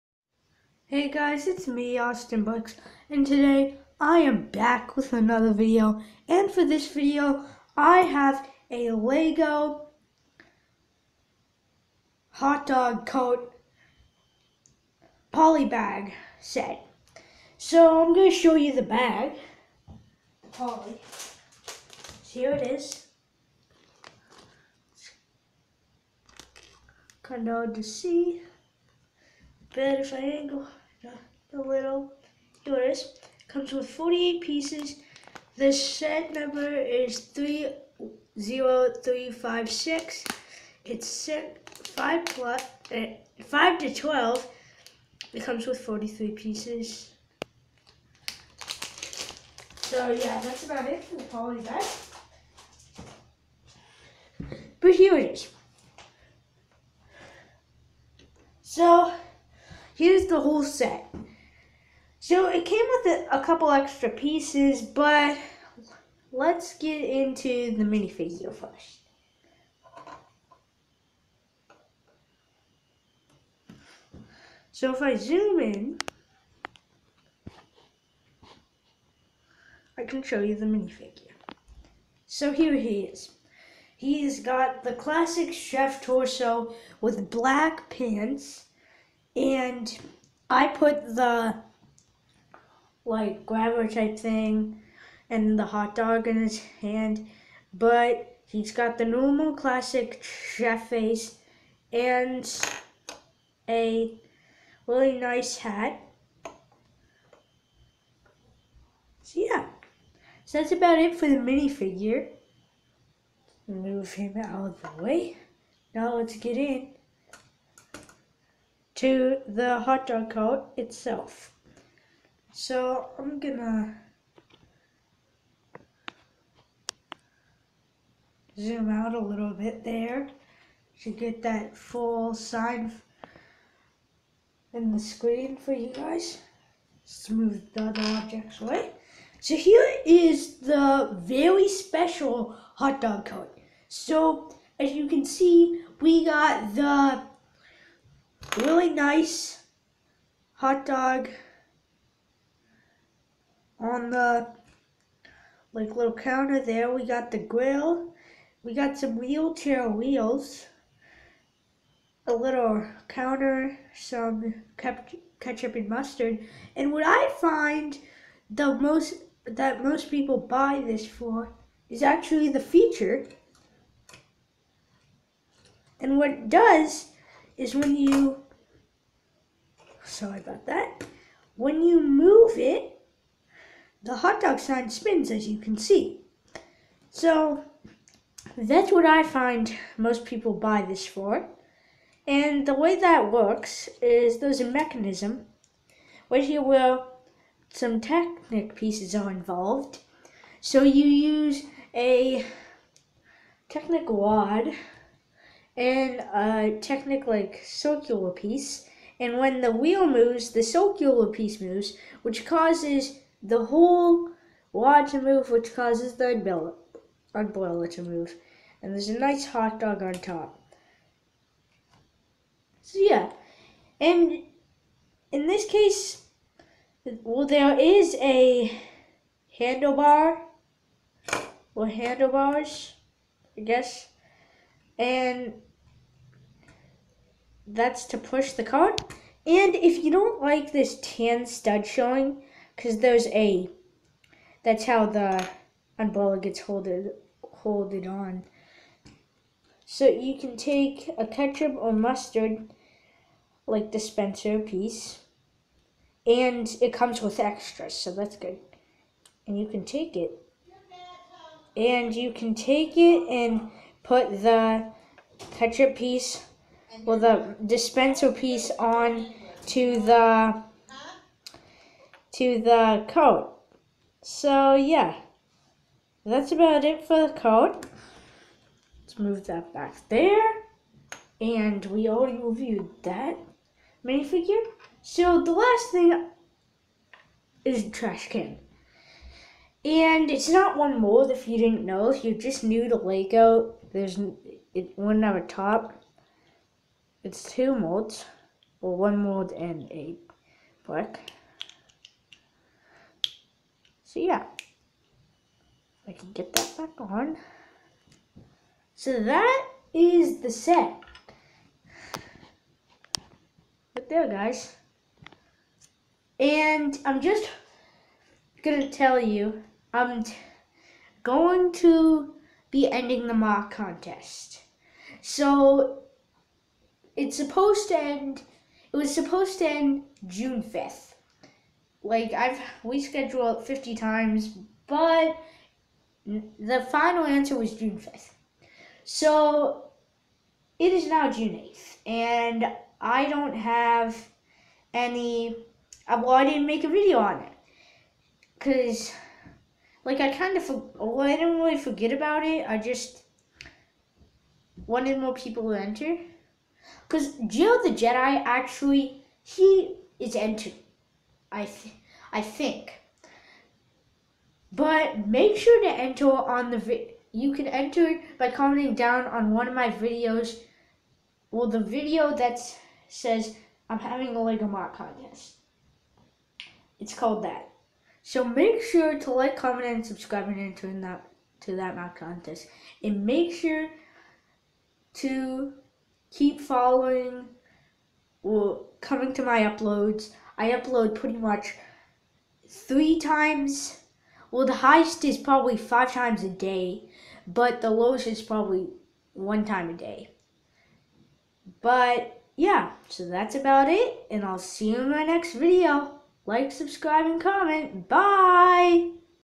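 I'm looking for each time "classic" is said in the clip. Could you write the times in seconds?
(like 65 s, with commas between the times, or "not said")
84 s, 99 s.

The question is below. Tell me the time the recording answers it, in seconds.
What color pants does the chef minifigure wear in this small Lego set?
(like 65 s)
87 s.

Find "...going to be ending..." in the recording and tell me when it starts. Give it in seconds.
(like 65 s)
321 s.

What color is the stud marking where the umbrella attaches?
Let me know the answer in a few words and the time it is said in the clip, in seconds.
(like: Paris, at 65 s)
Tan, at 241 s.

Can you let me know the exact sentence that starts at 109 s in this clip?
So yeah, so that's about it for the minifigure.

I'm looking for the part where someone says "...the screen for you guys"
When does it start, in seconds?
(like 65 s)
134 s.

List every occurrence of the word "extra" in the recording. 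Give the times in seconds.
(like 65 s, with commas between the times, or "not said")
63 s, 257 s.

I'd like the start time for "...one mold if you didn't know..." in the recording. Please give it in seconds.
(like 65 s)
290 s.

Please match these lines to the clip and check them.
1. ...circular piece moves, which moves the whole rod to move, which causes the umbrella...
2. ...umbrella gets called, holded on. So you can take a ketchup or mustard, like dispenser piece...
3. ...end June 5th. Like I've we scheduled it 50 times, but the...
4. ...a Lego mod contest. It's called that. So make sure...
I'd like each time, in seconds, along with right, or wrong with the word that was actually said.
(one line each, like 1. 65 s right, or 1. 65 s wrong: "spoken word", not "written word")
1. 210 s wrong: "causes", not "moves"
2. 245 s wrong: "holded", not "called"
3. 329 s right
4. 374 s right.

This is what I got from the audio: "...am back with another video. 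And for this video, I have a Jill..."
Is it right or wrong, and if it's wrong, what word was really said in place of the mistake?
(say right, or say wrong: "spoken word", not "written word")
wrong: "Lego", not "Jill".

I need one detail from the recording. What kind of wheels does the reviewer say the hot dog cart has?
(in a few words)
Wheelchair wheels.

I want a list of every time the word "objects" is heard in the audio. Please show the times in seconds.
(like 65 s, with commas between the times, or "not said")
138 s.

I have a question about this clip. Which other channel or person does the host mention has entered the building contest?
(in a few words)
Jill the Jedi.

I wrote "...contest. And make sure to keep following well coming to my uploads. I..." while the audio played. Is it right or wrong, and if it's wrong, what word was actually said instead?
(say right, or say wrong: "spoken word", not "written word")
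right.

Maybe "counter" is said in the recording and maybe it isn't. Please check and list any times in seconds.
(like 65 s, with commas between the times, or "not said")
156 s, 163 s.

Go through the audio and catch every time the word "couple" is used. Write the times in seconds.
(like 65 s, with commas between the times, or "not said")
63 s.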